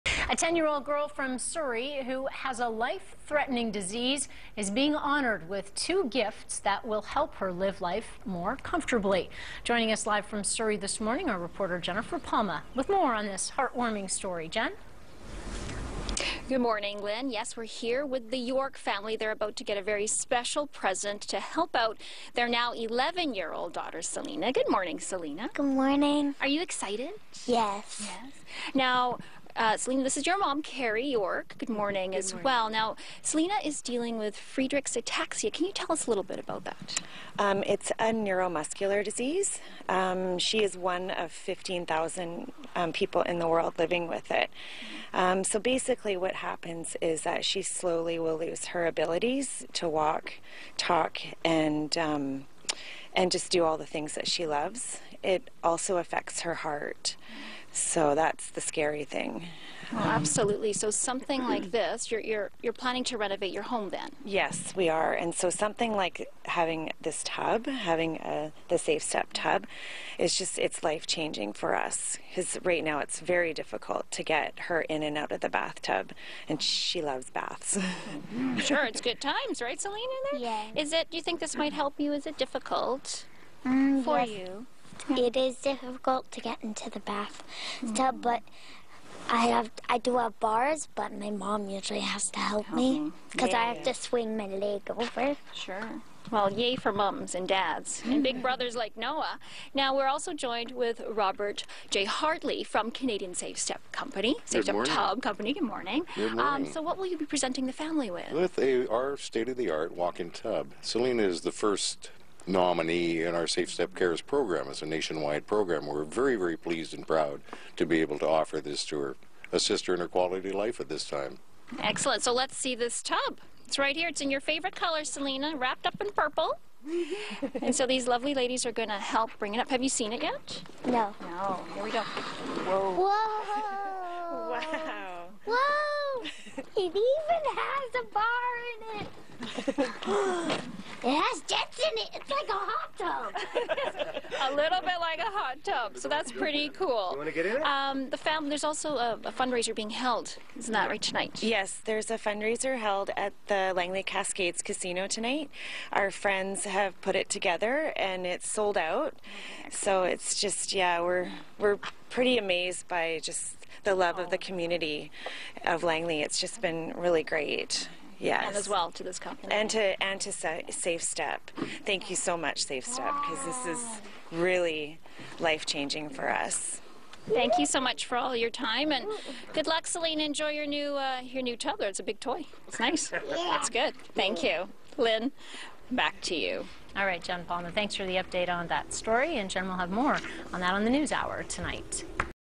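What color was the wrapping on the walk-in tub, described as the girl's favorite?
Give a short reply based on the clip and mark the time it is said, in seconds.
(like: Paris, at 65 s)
purple, at 126 s.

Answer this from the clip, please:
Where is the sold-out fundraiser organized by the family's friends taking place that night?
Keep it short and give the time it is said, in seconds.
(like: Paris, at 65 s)
Langley Cascades Casino, at 153 s.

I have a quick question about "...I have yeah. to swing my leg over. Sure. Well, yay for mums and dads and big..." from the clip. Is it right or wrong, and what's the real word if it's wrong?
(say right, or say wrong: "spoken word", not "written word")
right.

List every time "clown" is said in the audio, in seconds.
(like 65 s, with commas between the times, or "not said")
not said.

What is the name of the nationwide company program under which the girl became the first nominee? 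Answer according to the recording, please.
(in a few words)
Safe Step Cares.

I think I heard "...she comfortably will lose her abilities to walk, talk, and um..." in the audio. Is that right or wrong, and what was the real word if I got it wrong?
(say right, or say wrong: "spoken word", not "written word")
wrong: "slowly", not "comfortably".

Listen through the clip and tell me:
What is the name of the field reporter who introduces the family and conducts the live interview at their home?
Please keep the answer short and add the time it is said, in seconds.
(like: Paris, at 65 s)
Jennifer Palma, at 11 s.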